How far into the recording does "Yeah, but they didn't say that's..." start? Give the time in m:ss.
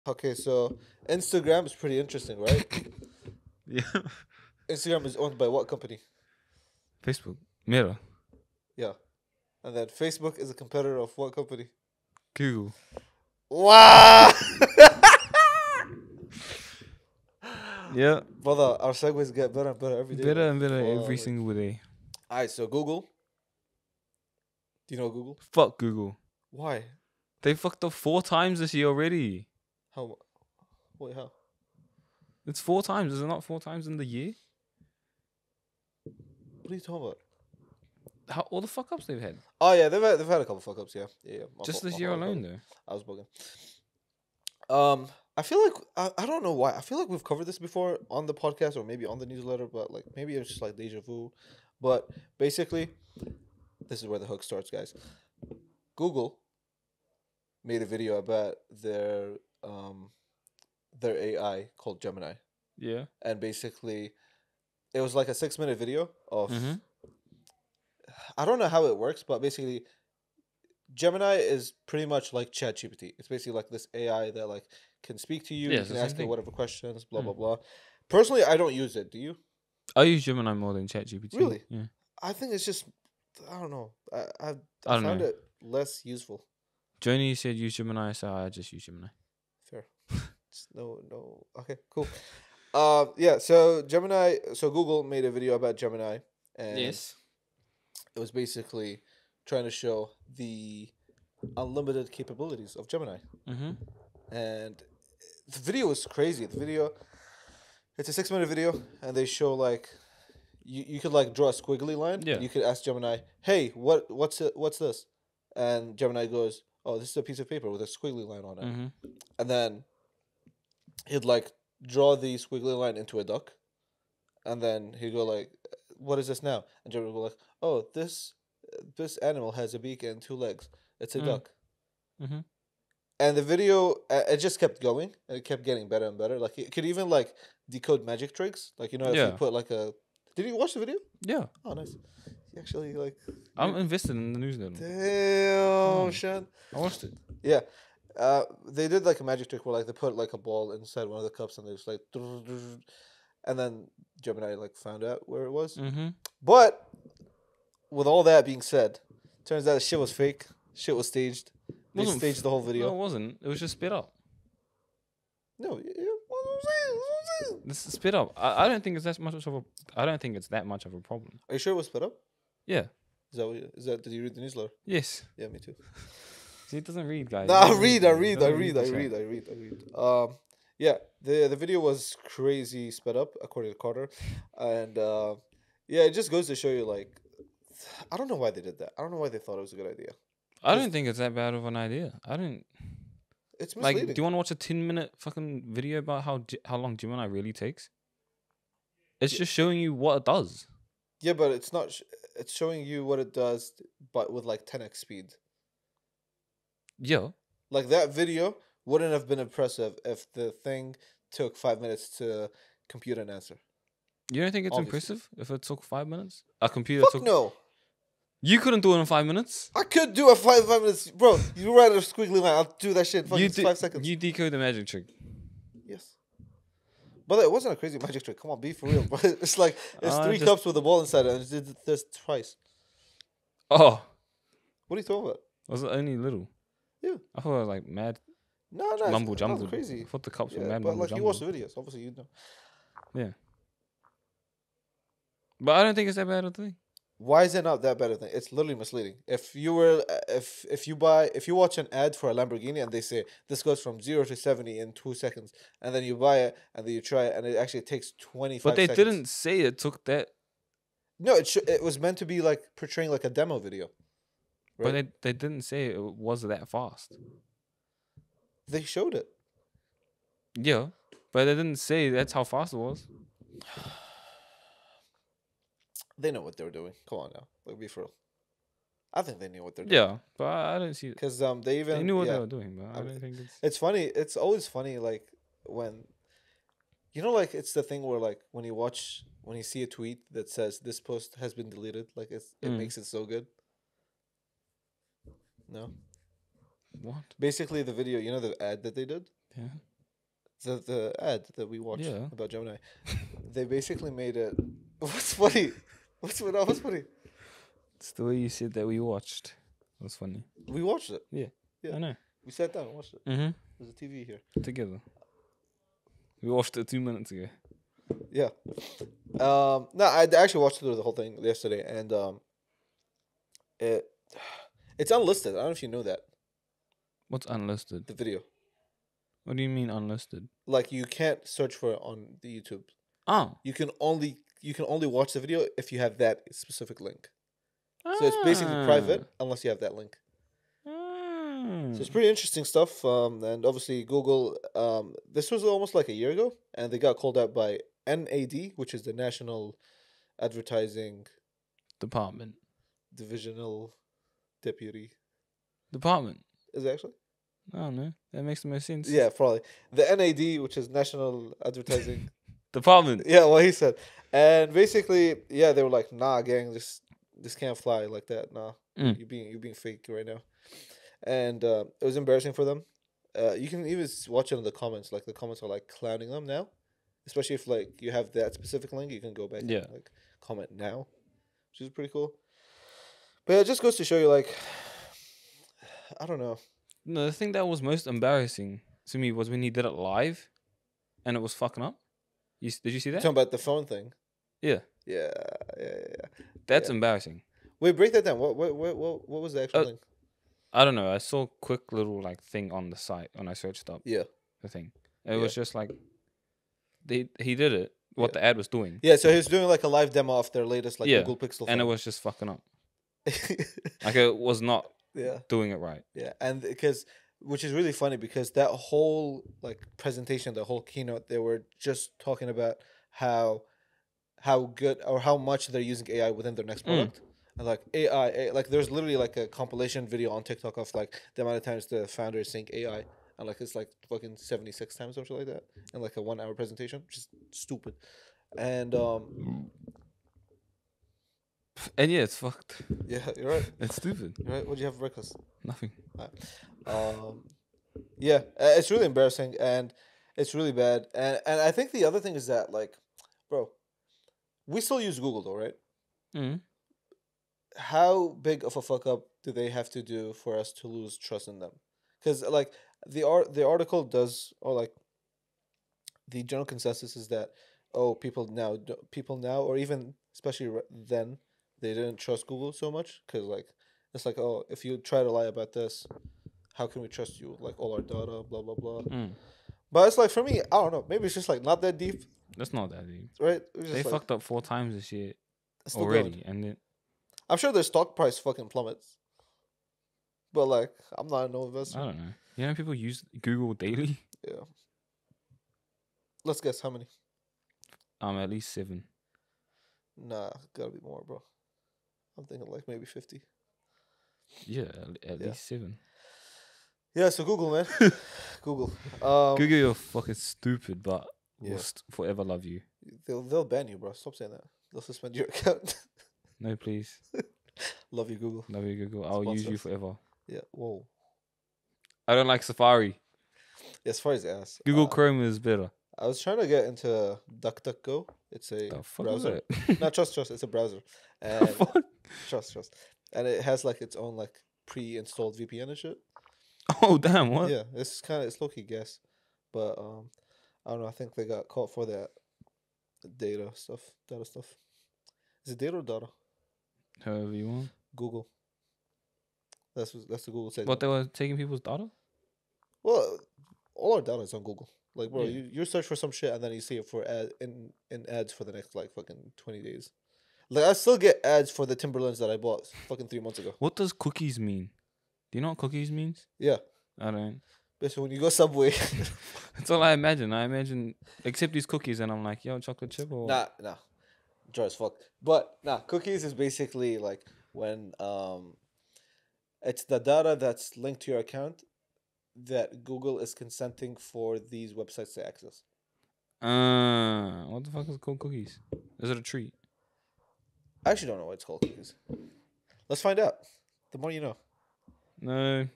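4:30.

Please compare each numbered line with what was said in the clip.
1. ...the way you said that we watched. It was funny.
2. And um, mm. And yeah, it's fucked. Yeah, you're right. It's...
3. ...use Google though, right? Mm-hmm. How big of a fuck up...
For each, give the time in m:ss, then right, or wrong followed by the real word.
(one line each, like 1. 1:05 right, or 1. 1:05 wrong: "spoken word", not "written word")
1. 5:08 right
2. 7:18 right
3. 7:35 right.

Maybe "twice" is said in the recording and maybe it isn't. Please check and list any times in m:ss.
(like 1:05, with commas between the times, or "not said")
3:52.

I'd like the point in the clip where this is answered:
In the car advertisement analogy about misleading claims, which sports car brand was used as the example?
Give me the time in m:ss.
4:12.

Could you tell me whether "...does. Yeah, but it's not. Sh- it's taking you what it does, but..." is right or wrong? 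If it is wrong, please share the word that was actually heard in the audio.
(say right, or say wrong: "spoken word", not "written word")
wrong: "showing", not "taking".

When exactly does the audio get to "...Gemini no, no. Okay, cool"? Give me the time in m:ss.
1:28.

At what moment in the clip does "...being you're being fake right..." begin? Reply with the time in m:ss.
6:09.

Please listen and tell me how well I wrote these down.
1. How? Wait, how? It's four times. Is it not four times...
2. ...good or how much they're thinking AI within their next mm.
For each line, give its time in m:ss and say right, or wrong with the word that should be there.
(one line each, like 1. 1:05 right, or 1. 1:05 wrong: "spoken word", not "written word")
1. 0:29 right
2. 7:04 wrong: "using", not "thinking".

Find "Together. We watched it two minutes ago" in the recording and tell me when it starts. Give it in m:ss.
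5:14.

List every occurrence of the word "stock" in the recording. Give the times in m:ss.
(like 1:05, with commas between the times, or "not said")
8:07.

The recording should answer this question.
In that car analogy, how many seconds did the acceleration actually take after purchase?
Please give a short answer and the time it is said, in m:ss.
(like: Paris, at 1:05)
25 seconds, at 4:18.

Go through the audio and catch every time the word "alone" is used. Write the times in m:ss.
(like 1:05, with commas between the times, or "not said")
0:42.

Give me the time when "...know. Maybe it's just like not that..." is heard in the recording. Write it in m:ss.
8:00.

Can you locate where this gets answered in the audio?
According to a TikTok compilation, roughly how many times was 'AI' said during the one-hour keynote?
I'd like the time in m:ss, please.
7:14.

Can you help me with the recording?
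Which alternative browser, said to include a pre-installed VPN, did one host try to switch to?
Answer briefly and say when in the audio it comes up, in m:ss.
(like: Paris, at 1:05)
DuckDuckGo, at 8:47.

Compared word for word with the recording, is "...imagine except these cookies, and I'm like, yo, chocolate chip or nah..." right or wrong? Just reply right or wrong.
right.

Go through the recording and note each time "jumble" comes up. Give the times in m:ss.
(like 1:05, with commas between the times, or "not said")
3:59.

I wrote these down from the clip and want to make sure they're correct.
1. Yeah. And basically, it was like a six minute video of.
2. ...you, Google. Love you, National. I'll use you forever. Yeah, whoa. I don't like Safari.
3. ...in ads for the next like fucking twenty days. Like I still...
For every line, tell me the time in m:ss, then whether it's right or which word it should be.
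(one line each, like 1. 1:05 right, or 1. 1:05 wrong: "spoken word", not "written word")
1. 1:02 right
2. 8:38 wrong: "Google", not "National"
3. 9:18 right.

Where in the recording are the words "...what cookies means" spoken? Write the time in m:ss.
9:25.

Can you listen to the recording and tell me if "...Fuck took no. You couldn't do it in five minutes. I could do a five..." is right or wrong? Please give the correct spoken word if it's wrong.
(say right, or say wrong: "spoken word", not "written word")
right.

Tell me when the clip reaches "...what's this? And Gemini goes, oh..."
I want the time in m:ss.
1:54.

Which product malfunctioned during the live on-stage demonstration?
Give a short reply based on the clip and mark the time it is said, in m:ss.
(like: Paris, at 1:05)
Google Pixel, at 6:51.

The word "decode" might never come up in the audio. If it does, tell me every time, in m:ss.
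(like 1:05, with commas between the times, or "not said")
2:17, 3:44.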